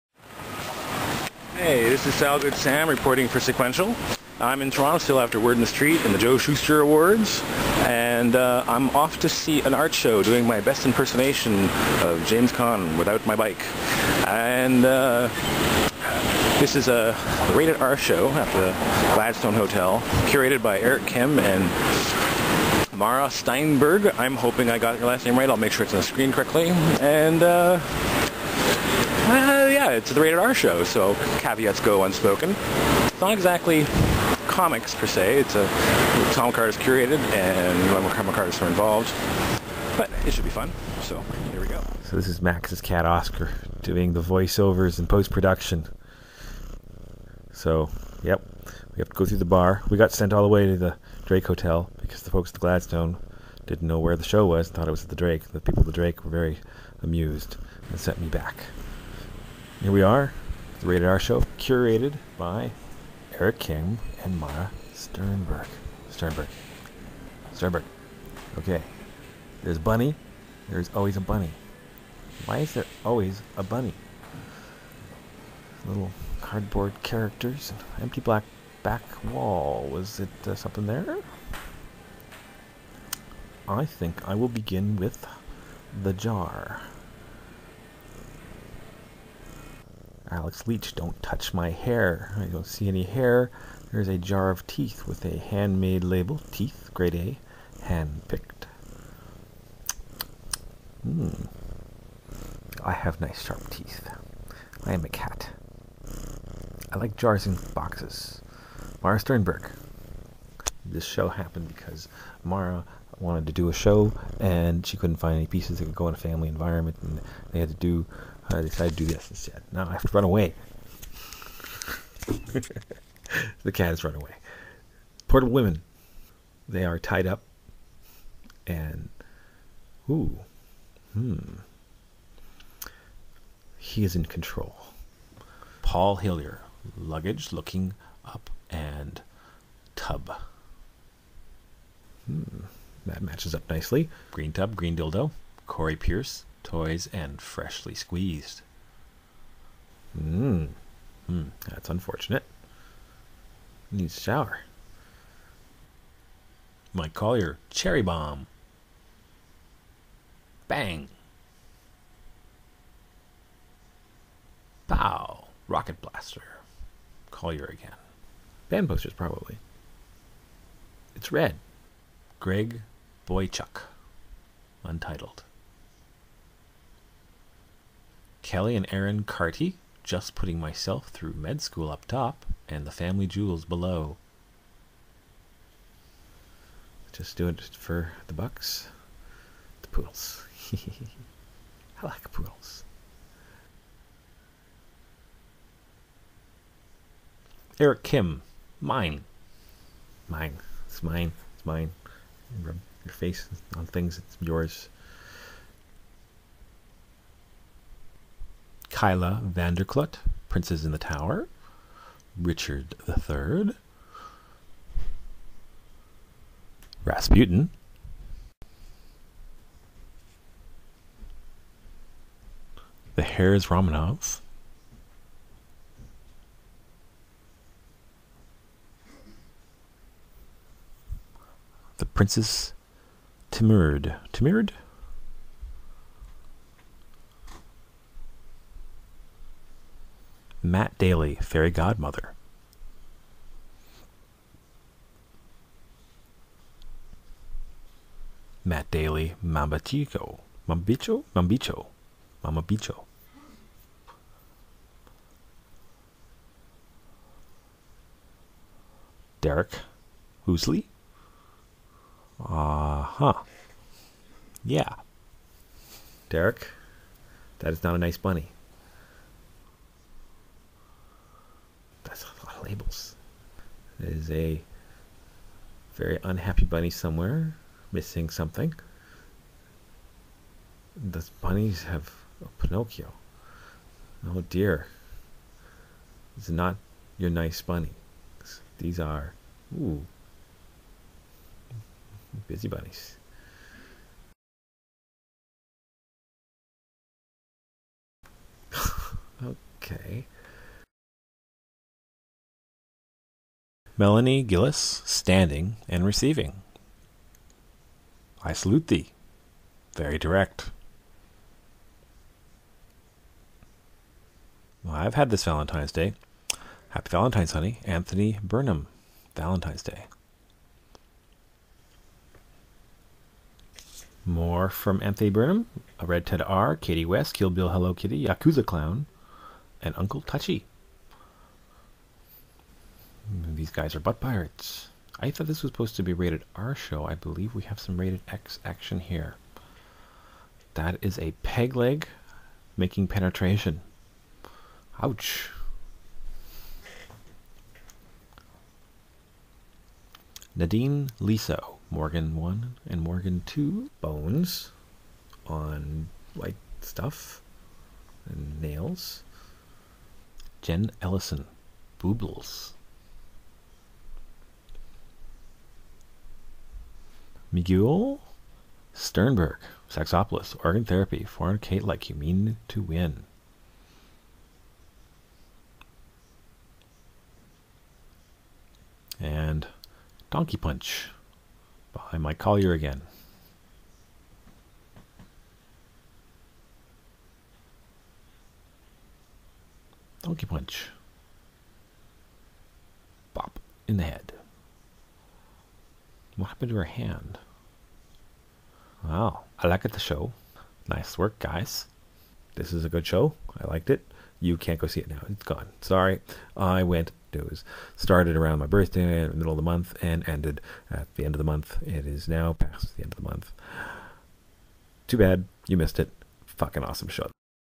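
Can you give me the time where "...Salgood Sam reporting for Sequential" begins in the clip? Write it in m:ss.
0:02.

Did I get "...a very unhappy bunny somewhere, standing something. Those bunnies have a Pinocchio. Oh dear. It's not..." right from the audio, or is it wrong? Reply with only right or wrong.
wrong.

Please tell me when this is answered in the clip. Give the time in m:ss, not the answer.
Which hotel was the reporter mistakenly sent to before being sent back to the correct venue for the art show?
0:51.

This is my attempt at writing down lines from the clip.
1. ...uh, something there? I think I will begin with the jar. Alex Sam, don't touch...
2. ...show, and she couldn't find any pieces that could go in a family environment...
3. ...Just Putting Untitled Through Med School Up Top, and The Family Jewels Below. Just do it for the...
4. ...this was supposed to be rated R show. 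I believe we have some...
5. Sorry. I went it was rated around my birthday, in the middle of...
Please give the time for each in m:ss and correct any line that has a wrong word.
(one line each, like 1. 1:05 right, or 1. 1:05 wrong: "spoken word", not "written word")
1. 1:20 wrong: "Leach", not "Sam"
2. 1:53 right
3. 3:00 wrong: "Myself", not "Untitled"
4. 5:35 right
5. 6:45 wrong: "started", not "rated".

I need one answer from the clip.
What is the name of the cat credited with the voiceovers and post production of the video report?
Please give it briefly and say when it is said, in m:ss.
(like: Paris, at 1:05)
Oscar, at 0:43.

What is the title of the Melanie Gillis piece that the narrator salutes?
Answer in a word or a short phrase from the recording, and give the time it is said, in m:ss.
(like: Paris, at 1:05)
Standing and Receiving, at 5:05.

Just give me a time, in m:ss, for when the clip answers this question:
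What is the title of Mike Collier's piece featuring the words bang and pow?
2:37.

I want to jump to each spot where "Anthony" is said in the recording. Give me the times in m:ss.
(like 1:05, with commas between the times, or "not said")
5:17, 5:25.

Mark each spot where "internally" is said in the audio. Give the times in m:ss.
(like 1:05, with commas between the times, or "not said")
not said.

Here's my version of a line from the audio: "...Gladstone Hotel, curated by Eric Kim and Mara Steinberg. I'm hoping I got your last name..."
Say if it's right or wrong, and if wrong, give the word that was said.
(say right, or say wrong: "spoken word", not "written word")
right.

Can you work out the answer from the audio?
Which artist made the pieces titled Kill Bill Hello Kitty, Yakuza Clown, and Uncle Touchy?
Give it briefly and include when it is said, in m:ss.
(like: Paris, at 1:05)
Katie West, at 5:26.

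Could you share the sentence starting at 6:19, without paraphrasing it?
And Donkey Punch behind my collier again.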